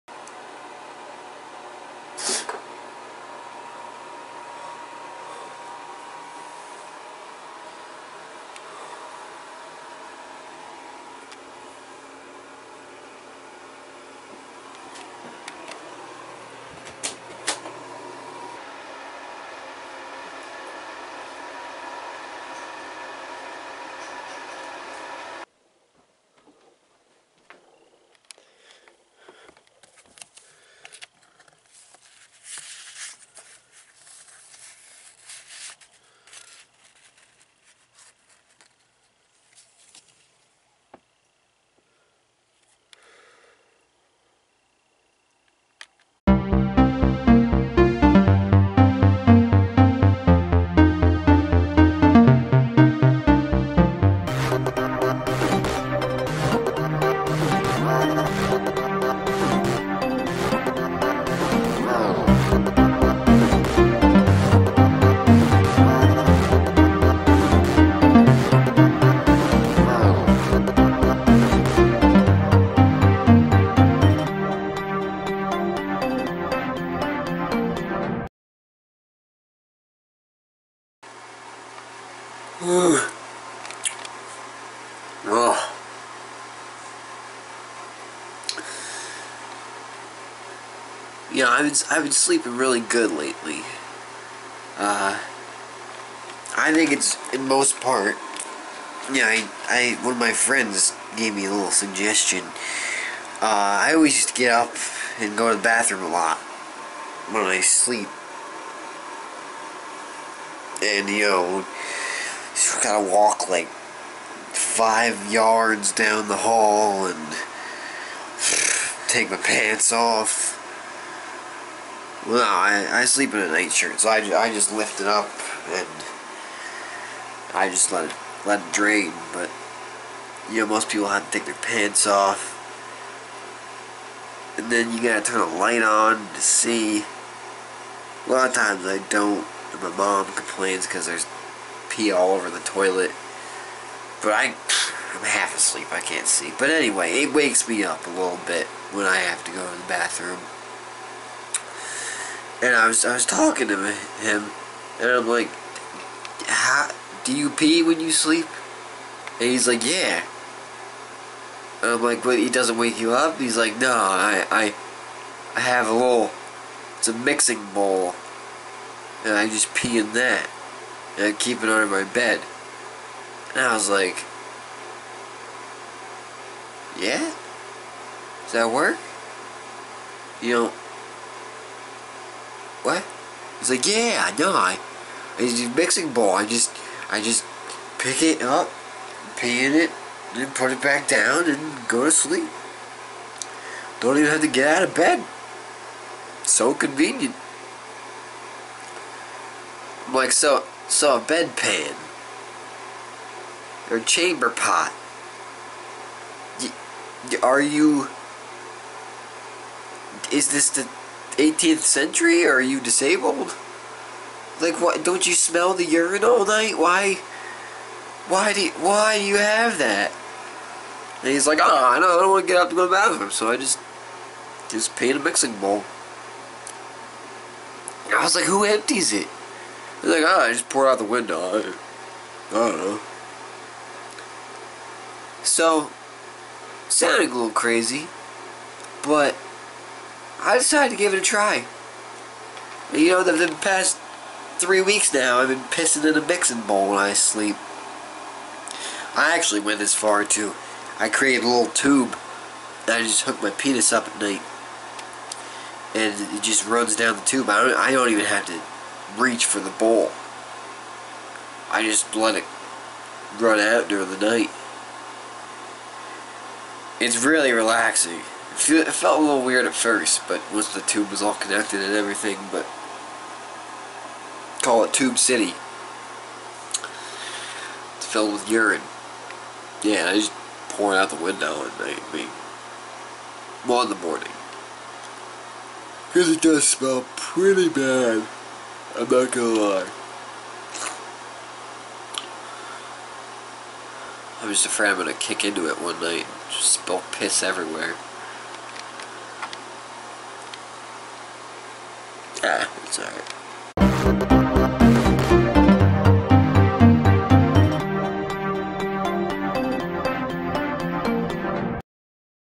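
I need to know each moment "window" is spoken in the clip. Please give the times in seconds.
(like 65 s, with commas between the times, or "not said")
231 s, 281 s.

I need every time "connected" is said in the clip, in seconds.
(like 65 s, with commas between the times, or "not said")
271 s.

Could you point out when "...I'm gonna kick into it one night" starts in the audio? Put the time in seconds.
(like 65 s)
294 s.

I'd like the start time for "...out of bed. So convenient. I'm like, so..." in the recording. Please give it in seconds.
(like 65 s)
194 s.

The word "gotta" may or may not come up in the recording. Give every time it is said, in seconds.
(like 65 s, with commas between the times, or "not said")
112 s, 135 s.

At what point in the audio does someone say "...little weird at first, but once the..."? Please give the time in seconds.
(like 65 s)
269 s.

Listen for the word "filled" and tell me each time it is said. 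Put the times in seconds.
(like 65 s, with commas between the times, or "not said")
278 s.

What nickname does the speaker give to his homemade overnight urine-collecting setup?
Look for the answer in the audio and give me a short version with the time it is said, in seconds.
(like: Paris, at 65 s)
Tube City, at 274 s.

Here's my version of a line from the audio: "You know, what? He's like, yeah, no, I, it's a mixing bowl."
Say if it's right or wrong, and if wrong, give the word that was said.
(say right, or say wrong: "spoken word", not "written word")
right.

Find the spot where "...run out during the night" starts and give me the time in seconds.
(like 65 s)
263 s.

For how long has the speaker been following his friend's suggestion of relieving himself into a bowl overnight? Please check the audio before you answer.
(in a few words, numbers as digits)
3 weeks.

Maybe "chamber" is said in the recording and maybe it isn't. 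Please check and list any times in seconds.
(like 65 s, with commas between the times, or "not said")
203 s.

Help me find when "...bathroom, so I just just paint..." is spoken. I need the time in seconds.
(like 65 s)
222 s.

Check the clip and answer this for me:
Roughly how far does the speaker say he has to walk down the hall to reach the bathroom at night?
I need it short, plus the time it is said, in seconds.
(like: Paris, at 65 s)
5 yards, at 113 s.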